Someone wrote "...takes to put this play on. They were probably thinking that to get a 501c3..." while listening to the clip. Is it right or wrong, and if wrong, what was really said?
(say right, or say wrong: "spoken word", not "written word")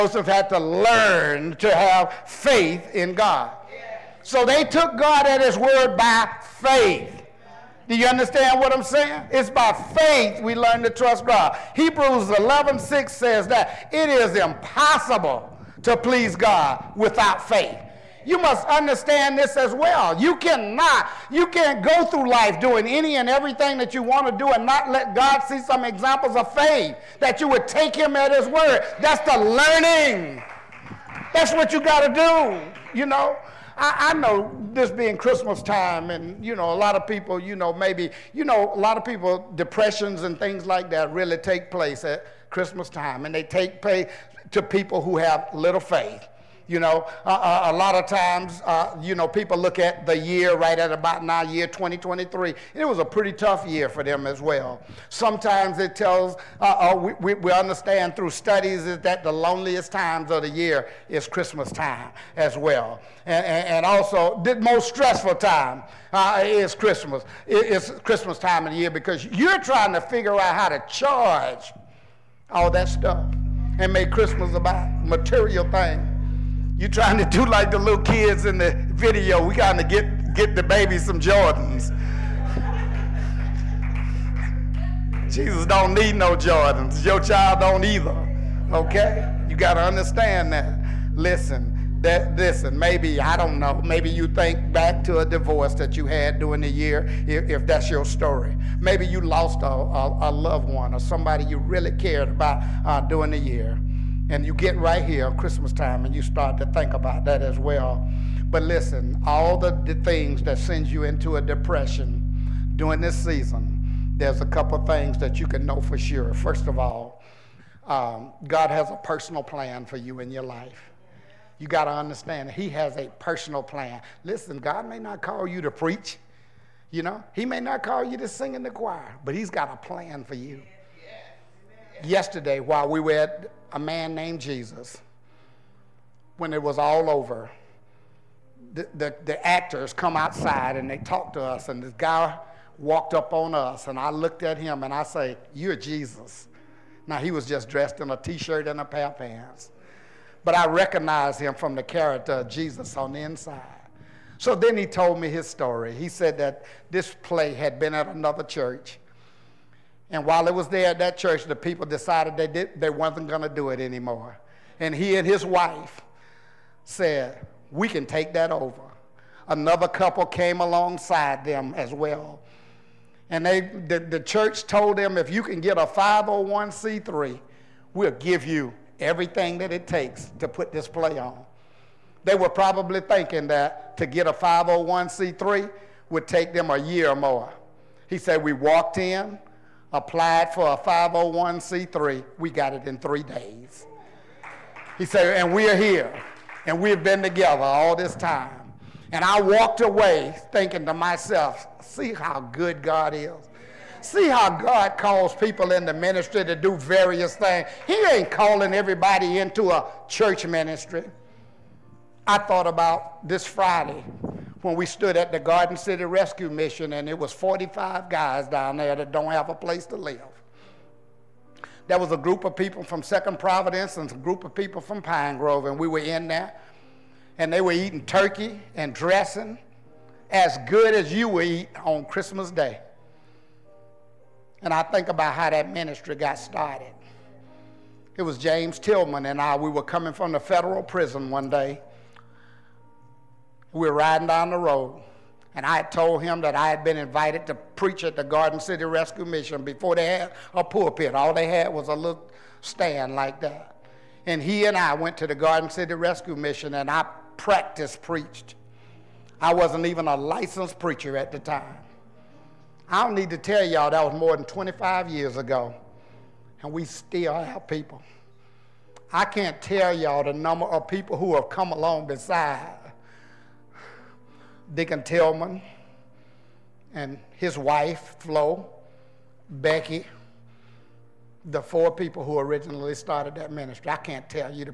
right.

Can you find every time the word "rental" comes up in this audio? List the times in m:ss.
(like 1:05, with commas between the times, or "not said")
not said.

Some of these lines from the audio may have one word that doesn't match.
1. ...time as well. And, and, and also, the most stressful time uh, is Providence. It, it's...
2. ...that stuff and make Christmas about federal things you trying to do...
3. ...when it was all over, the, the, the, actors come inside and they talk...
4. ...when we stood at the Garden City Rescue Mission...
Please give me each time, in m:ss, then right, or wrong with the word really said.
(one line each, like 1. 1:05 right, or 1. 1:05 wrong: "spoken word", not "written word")
1. 1:01 wrong: "Christmas", not "Providence"
2. 1:12 wrong: "material", not "federal"
3. 2:16 wrong: "outside", not "inside"
4. 3:34 right.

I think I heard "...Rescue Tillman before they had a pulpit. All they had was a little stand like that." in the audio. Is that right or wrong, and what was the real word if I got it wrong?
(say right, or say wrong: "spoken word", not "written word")
wrong: "Mission", not "Tillman".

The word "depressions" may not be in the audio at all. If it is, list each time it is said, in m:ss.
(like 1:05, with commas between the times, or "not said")
0:39, 1:51.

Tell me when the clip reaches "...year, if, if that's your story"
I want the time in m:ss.
1:36.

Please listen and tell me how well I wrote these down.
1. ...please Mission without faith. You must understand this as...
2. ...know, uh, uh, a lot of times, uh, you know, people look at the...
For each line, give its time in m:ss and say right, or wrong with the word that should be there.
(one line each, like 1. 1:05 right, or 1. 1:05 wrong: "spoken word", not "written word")
1. 0:15 wrong: "God", not "Mission"
2. 0:46 right.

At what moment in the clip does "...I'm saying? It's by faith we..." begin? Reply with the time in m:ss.
0:08.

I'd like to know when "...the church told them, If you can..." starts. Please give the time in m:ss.
2:53.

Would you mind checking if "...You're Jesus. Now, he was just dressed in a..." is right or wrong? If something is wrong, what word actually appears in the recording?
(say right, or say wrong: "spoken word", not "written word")
right.